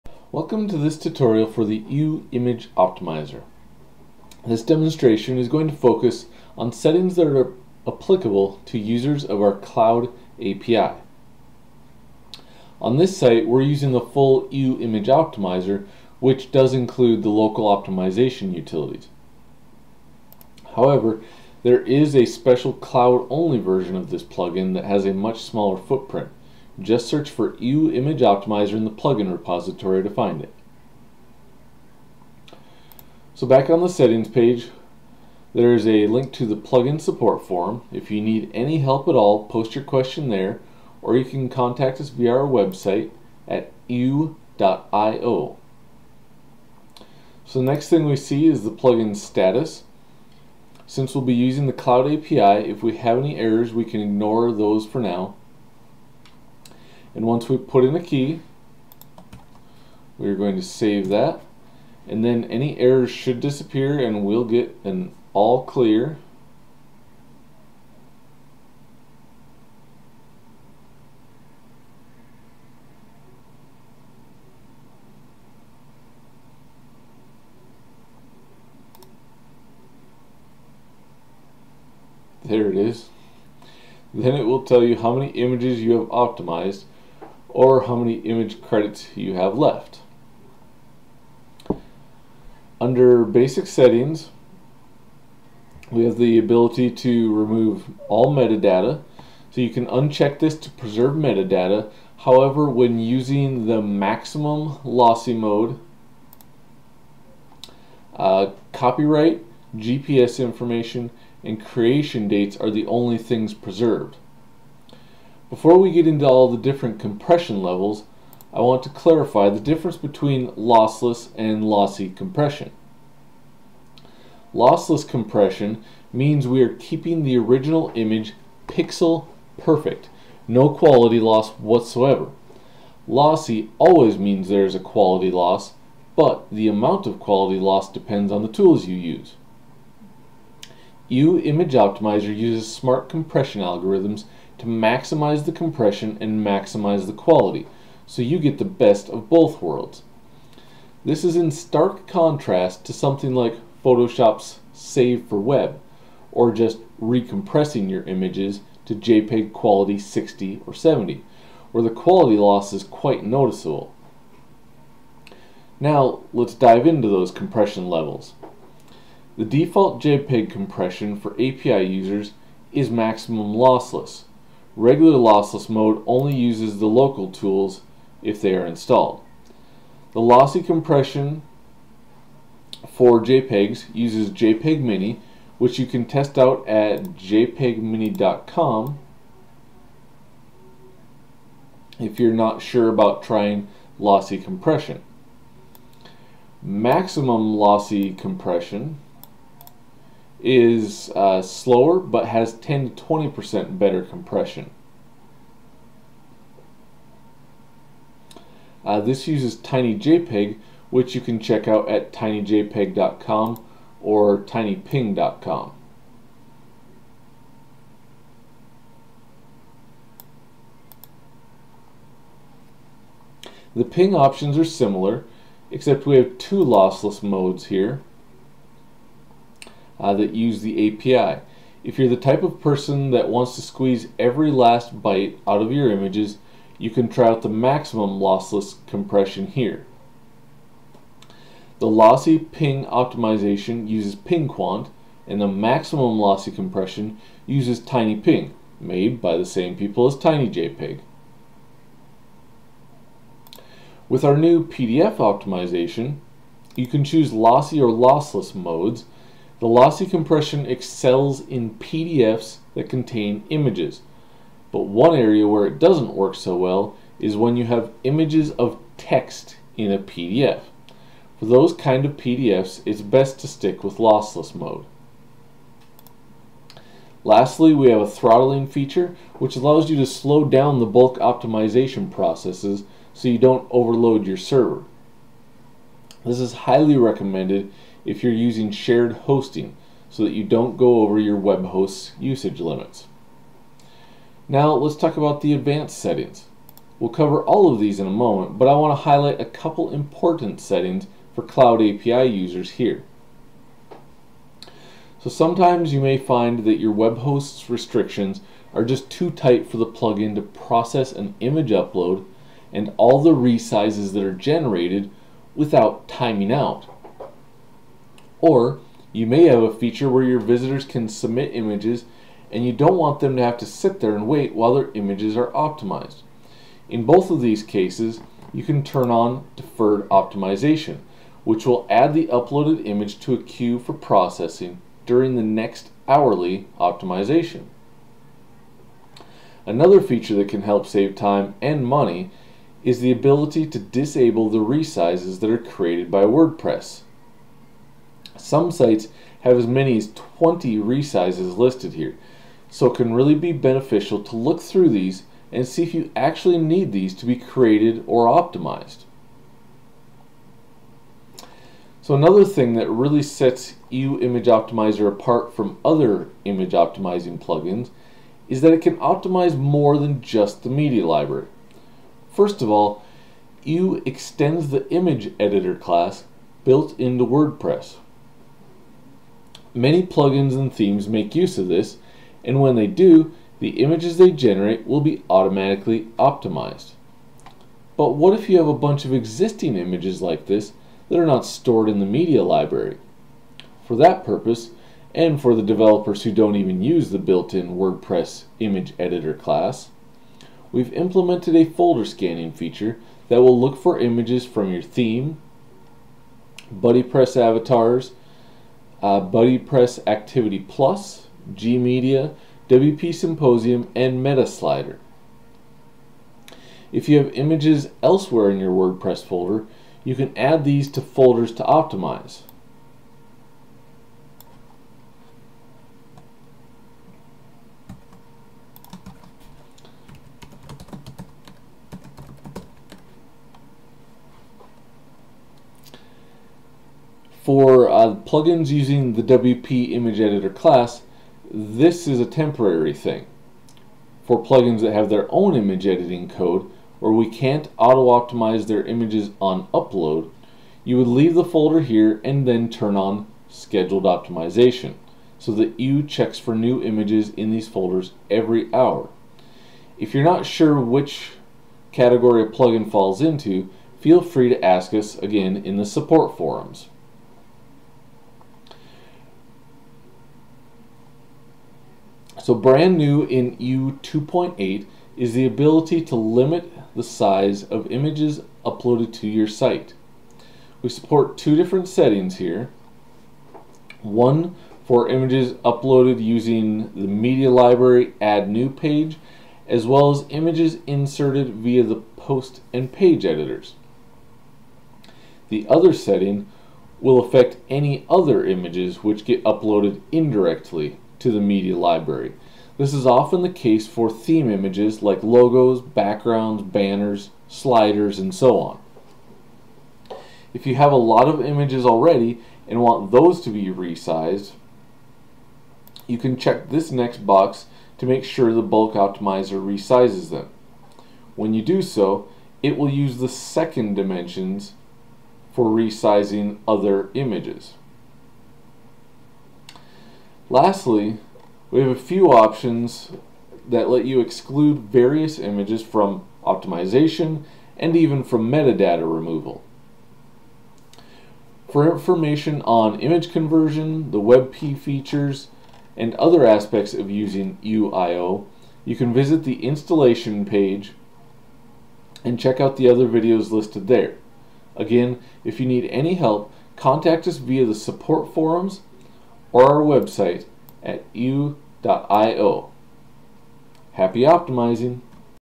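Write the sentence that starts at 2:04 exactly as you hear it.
Lossless compression means we are keeping the original image pixel perfect, no quality loss whatsoever.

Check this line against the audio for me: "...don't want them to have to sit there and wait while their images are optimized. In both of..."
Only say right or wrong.
right.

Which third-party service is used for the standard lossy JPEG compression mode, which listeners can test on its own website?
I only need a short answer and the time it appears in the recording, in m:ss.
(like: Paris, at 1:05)
JPEGmini, at 3:04.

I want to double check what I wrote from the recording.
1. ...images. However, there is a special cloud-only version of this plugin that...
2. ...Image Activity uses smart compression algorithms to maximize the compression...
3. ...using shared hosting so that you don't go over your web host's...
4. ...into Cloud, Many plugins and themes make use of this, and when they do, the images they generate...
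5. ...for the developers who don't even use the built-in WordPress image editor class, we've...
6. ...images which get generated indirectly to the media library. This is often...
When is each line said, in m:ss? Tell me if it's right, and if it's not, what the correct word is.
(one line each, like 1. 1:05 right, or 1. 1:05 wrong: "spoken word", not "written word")
1. 0:18 wrong: "utilities", not "images"
2. 2:21 wrong: "Optimizer", not "Activity"
3. 4:48 right
4. 6:16 wrong: "WordPress", not "Cloud"
5. 6:35 right
6. 8:18 wrong: "uploaded", not "generated".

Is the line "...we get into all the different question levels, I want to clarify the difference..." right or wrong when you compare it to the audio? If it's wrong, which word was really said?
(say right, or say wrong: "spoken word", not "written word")
wrong: "compression", not "question".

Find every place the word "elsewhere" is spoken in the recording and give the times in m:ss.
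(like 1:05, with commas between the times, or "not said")
6:58.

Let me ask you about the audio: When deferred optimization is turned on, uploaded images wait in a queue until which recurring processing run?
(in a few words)
hourly optimization.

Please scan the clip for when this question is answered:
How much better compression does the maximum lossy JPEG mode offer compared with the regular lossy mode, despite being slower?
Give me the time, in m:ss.
3:22.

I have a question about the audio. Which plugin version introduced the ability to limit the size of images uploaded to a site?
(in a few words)
2.8.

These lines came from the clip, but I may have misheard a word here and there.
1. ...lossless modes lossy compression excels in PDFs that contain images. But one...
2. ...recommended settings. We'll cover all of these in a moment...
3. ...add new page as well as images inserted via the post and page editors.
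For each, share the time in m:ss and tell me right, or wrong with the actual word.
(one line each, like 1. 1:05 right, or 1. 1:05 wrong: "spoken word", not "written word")
1. 4:17 right
2. 4:55 wrong: "advanced", not "recommended"
3. 8:08 right.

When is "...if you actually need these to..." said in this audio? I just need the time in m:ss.
5:55.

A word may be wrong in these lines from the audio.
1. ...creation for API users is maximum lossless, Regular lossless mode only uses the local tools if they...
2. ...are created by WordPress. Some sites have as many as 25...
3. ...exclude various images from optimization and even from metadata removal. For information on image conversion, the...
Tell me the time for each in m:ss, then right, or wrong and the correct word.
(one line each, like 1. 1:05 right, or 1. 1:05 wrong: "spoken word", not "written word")
1. 2:50 wrong: "compression", not "creation"
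2. 5:45 wrong: "20", not "25"
3. 8:54 right.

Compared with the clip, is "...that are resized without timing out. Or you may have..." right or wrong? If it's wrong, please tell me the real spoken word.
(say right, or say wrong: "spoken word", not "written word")
wrong: "generated", not "resized".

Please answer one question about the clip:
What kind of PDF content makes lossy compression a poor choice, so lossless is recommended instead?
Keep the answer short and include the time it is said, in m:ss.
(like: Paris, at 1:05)
images of text, at 4:28.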